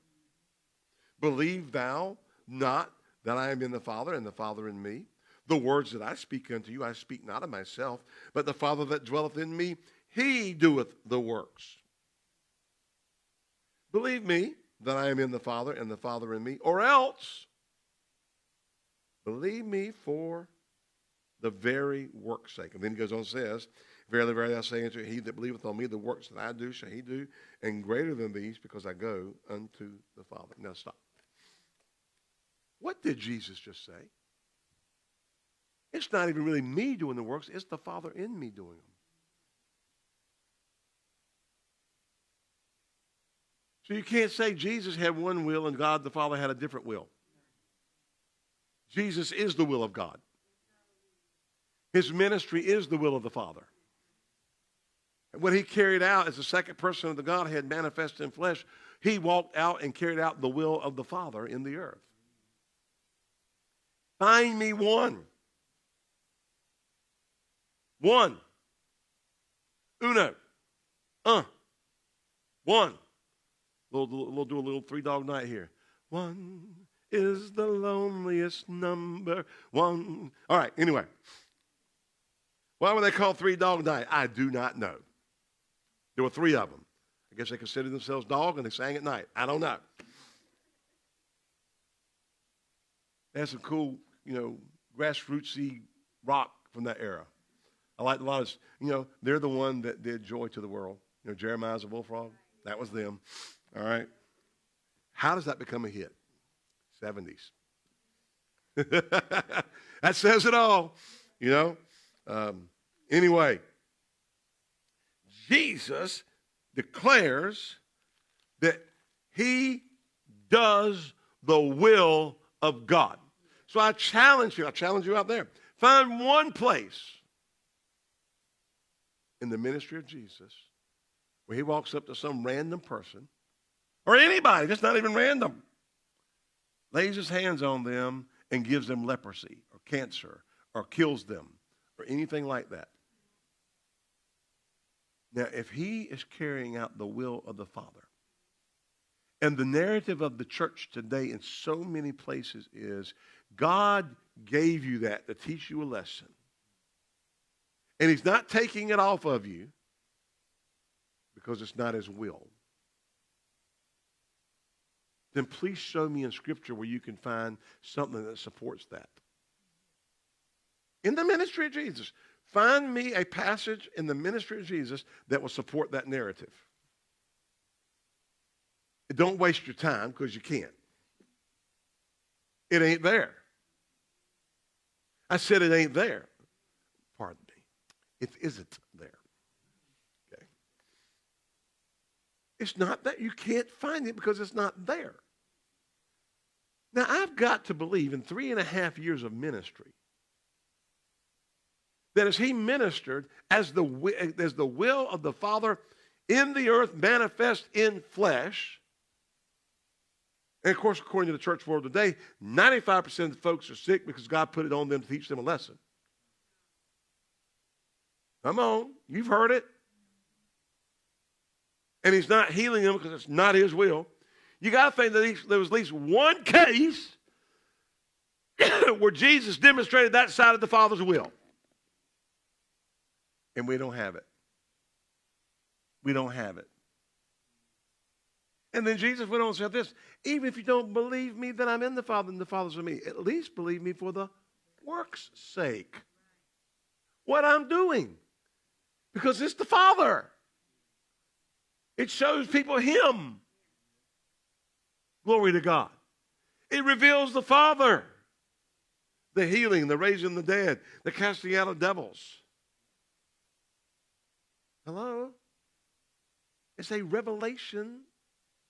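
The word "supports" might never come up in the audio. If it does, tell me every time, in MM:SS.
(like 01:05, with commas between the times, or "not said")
02:48, 02:55.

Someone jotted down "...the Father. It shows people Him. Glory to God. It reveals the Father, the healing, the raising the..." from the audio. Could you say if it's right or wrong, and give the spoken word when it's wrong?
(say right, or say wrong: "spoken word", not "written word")
right.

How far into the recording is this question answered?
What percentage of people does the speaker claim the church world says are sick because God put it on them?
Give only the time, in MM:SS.
03:32.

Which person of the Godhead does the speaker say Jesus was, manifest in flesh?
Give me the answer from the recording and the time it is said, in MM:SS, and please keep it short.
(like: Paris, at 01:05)
Second person, at 00:56.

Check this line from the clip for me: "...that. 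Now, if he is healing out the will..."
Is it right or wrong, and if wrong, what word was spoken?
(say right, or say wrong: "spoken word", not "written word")
wrong: "carrying", not "healing".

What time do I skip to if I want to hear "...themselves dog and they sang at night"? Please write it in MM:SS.
01:27.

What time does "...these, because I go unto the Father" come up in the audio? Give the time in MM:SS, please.
00:28.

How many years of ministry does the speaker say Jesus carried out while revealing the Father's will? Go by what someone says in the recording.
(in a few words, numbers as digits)
3.5 years.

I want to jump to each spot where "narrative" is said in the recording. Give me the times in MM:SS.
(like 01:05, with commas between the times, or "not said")
02:29, 02:56.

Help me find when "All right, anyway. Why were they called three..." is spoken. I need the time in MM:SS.
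01:20.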